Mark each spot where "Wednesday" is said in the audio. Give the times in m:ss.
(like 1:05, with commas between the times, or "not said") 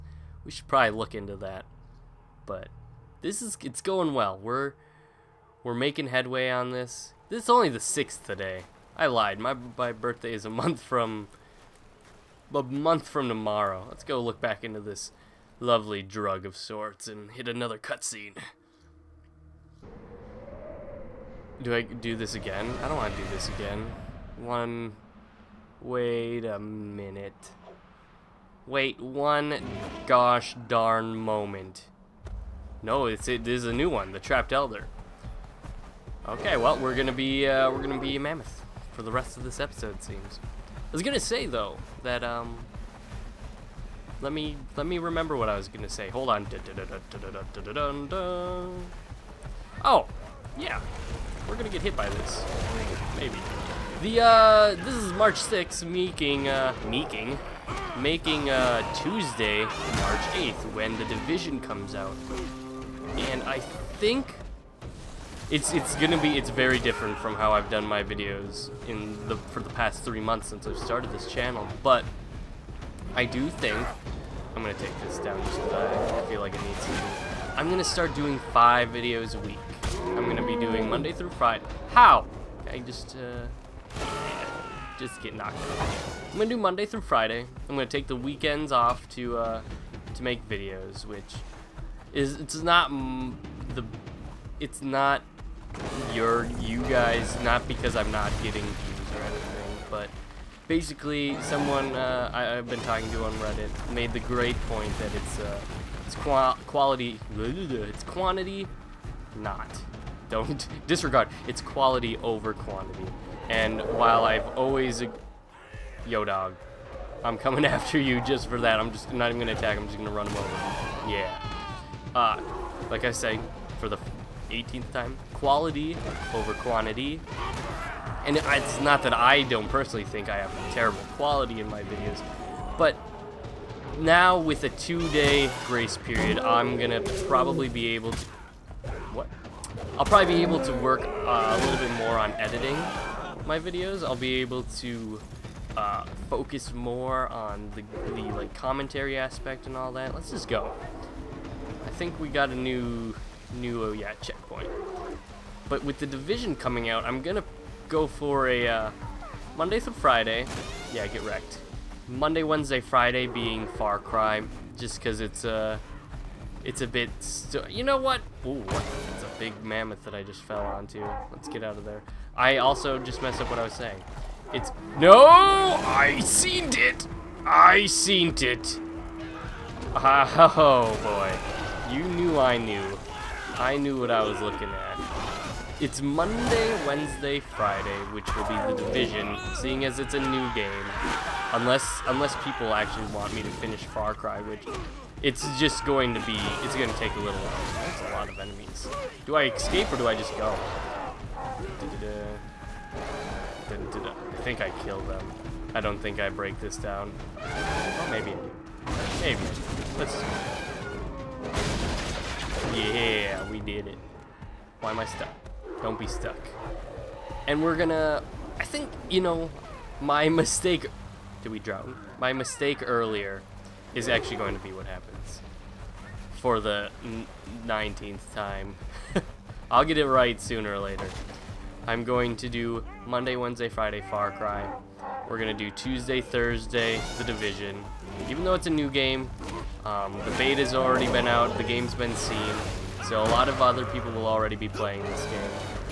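2:42, 3:06, 3:53.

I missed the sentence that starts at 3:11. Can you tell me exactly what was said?
Unless unless people actually want me to finish Far Cry, which it's just going to be it's gonna take a little while.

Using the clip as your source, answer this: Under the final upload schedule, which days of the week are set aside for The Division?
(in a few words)
Tuesday, Thursday.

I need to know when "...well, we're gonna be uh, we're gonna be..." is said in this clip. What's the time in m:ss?
0:36.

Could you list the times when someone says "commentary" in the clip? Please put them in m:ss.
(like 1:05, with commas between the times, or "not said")
2:28.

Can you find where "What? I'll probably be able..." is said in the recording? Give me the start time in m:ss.
2:19.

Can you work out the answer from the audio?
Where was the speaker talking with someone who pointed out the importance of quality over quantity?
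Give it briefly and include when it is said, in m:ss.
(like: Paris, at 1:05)
Reddit, at 1:43.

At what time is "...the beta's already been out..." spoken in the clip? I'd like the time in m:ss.
4:00.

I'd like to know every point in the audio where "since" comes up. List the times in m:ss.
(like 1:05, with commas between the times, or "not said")
1:10.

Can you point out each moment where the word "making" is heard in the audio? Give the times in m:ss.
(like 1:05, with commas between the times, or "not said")
0:05, 0:57.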